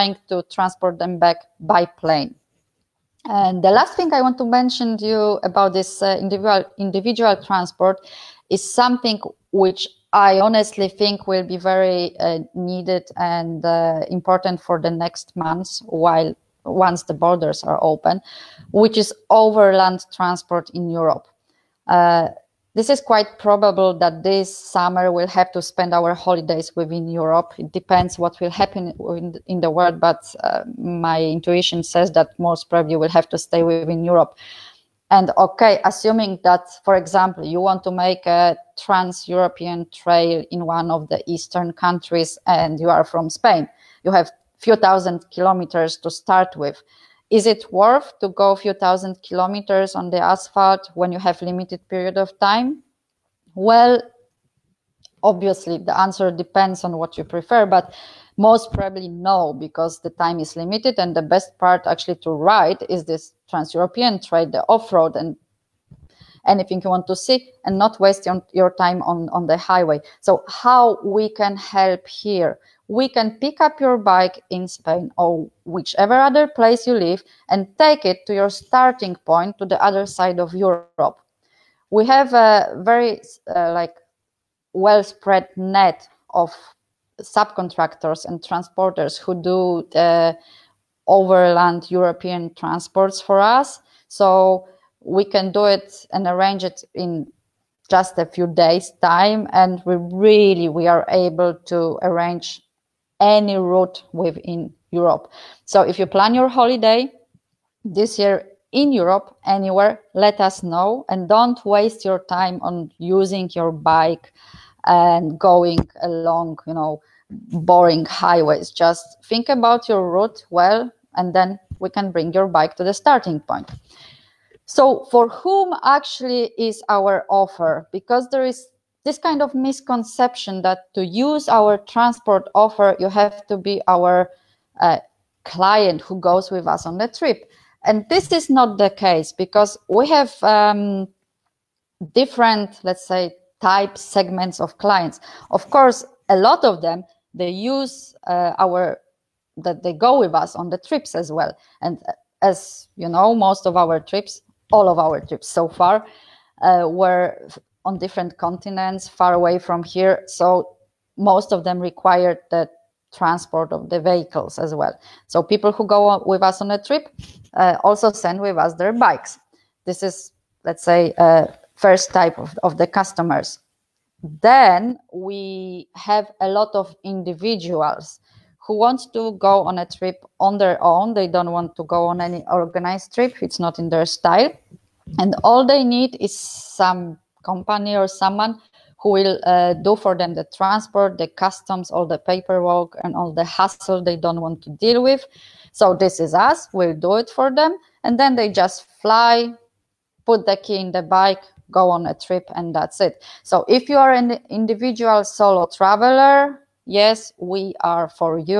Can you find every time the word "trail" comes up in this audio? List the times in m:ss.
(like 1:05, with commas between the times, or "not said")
0:39, 1:04.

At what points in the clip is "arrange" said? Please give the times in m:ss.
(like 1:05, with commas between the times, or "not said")
1:36, 1:42.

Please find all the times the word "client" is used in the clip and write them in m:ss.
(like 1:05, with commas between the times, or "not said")
2:15, 2:24.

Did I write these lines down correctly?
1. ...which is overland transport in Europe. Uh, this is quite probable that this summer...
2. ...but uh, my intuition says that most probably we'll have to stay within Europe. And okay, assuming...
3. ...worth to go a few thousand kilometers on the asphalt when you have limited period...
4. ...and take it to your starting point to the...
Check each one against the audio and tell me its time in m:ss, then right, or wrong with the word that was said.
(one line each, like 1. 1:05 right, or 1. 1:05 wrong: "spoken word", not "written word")
1. 0:18 right
2. 0:29 right
3. 0:47 right
4. 1:17 right.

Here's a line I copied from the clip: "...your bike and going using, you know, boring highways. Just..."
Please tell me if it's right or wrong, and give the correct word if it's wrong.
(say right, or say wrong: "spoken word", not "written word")
wrong: "along", not "using".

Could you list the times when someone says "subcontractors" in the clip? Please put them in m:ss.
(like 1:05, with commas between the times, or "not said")
1:27.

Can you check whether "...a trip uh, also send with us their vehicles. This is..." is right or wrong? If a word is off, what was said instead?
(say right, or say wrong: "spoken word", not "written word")
wrong: "bikes", not "vehicles".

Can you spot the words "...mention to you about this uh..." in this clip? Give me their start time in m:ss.
0:04.